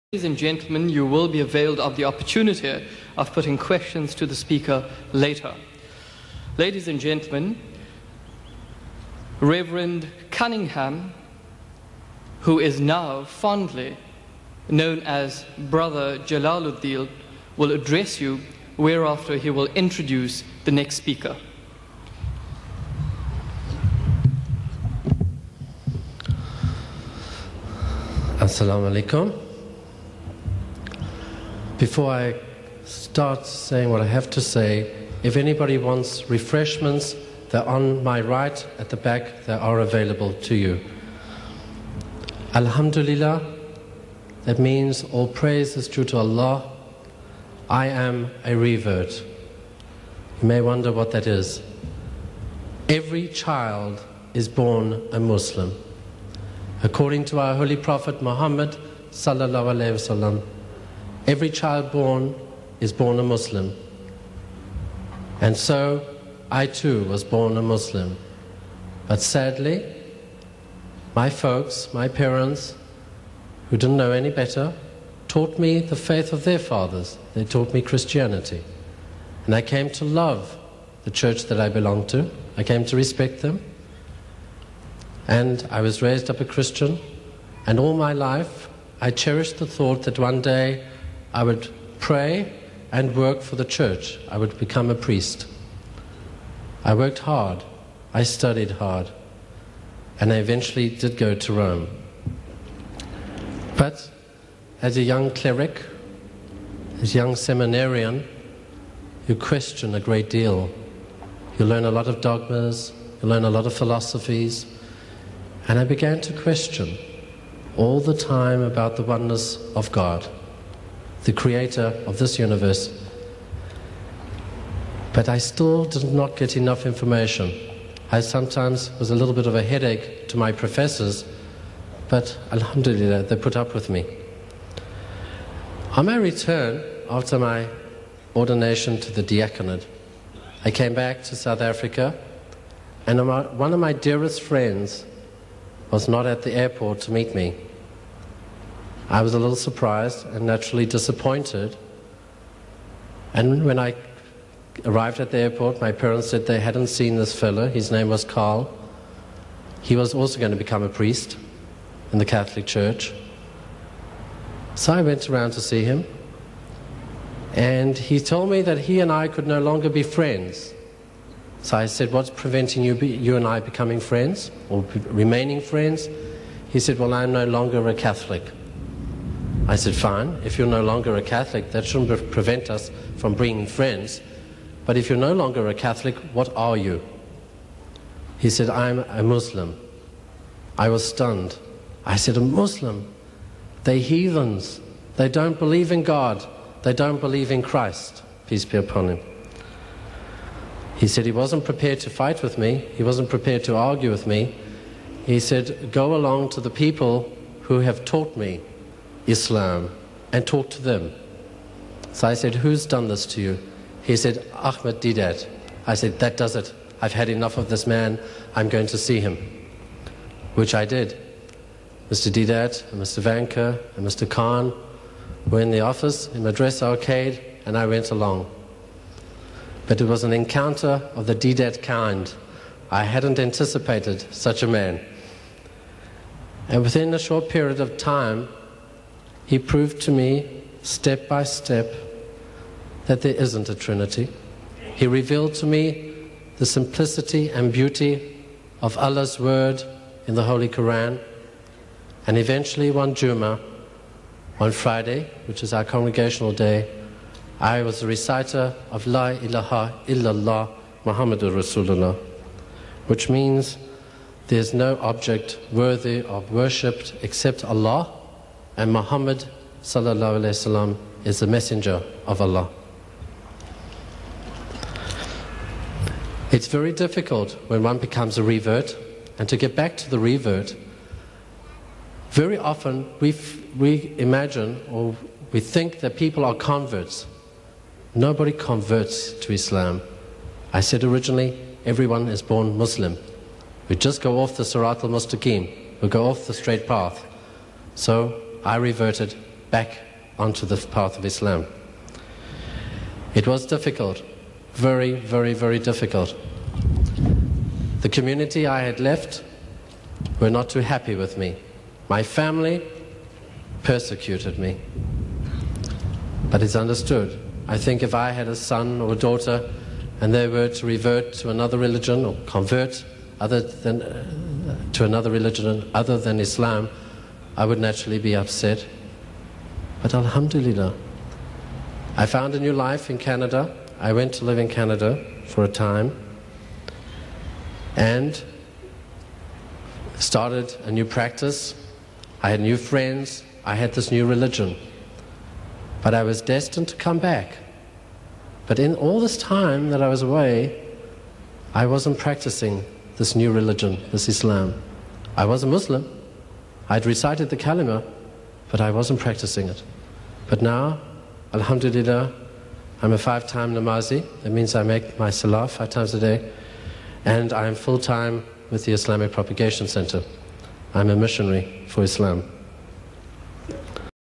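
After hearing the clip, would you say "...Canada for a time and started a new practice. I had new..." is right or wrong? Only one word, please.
right.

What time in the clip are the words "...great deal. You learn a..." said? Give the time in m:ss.
1:50.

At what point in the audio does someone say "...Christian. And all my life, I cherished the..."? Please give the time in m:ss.
1:26.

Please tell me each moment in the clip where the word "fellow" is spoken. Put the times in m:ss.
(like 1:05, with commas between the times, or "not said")
2:37.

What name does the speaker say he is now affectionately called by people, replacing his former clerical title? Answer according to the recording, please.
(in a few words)
Brother Jalaluddin.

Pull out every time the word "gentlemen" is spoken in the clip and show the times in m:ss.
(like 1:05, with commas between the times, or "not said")
0:00, 0:06.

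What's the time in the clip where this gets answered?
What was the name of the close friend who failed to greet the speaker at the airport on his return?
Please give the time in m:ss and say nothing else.
2:38.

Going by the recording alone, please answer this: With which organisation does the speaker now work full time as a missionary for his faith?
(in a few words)
Islamic Propagation Center.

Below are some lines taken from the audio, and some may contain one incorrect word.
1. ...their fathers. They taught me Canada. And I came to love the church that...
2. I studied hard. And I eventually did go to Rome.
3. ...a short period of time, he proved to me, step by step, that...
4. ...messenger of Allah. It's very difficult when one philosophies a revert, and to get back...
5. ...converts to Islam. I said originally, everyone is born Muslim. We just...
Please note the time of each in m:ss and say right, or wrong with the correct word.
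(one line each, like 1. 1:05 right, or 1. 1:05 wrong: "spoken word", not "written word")
1. 1:16 wrong: "Christianity", not "Canada"
2. 1:38 right
3. 3:57 right
4. 4:31 wrong: "becomes", not "philosophies"
5. 4:48 right.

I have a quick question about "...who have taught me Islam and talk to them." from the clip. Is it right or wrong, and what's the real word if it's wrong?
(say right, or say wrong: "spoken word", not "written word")
right.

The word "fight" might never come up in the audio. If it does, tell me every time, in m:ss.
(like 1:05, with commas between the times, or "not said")
3:22.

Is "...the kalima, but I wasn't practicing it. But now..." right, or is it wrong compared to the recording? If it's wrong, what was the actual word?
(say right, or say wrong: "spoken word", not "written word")
right.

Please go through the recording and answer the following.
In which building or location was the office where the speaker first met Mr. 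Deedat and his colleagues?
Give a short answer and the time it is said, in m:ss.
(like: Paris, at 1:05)
Madressa Arcade, at 3:46.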